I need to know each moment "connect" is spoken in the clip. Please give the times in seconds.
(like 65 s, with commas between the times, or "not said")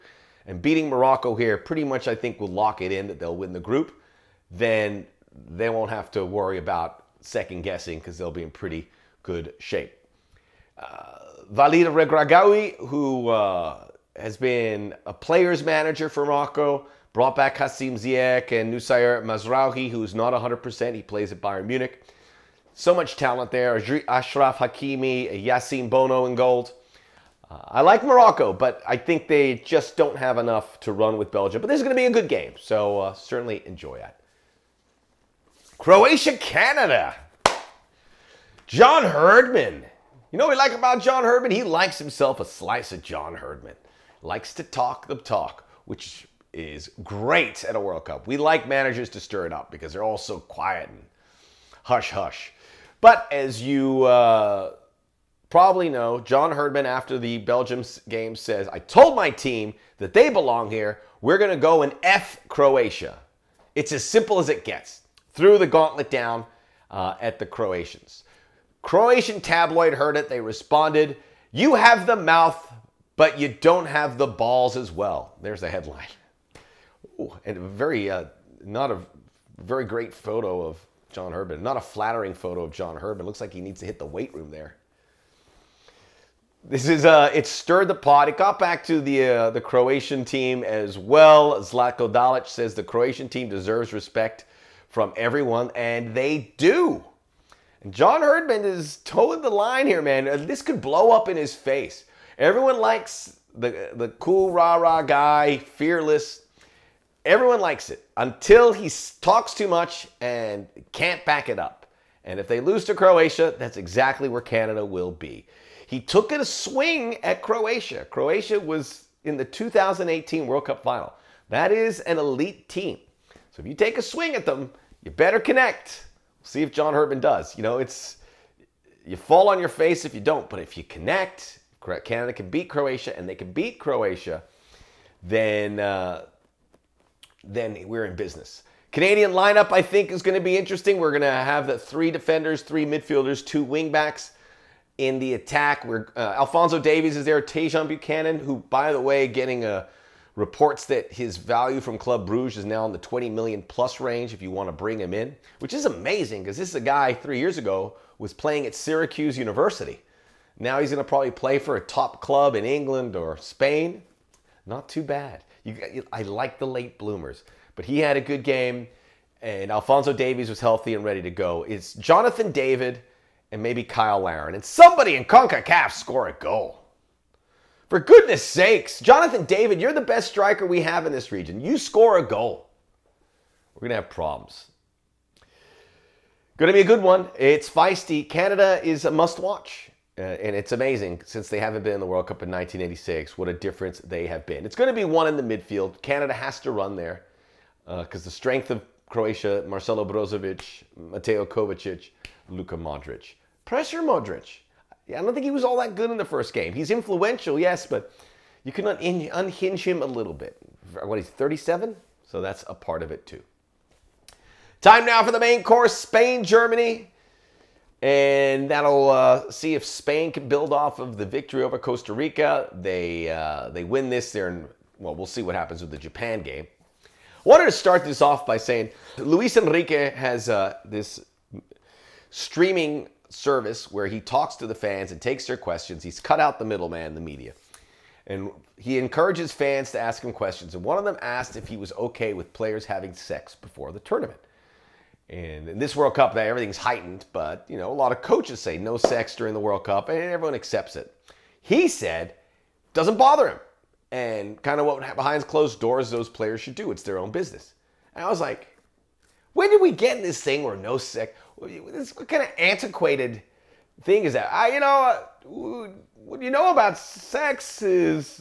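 125 s, 130 s.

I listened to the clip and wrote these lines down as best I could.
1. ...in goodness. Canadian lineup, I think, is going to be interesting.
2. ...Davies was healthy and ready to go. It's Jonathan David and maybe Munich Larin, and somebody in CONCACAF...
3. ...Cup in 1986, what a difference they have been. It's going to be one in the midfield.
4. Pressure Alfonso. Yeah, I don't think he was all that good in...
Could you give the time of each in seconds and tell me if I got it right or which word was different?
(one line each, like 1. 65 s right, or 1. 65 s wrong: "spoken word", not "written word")
1. 138 s wrong: "business", not "goodness"
2. 170 s wrong: "Cyle", not "Munich"
3. 192 s right
4. 203 s wrong: "Modric", not "Alfonso".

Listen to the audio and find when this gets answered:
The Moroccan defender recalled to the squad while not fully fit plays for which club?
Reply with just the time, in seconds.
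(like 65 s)
21 s.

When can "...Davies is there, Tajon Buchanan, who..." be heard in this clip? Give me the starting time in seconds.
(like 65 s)
146 s.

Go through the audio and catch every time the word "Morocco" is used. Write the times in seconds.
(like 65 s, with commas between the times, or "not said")
0 s, 16 s, 28 s.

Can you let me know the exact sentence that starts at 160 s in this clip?
Now he's going to probably play for a top club in England or Spain.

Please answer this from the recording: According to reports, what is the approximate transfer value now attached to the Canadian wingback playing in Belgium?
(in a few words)
20 million plus.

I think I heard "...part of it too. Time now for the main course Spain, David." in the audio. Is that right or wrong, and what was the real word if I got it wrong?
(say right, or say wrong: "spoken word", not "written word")
wrong: "Germany", not "David".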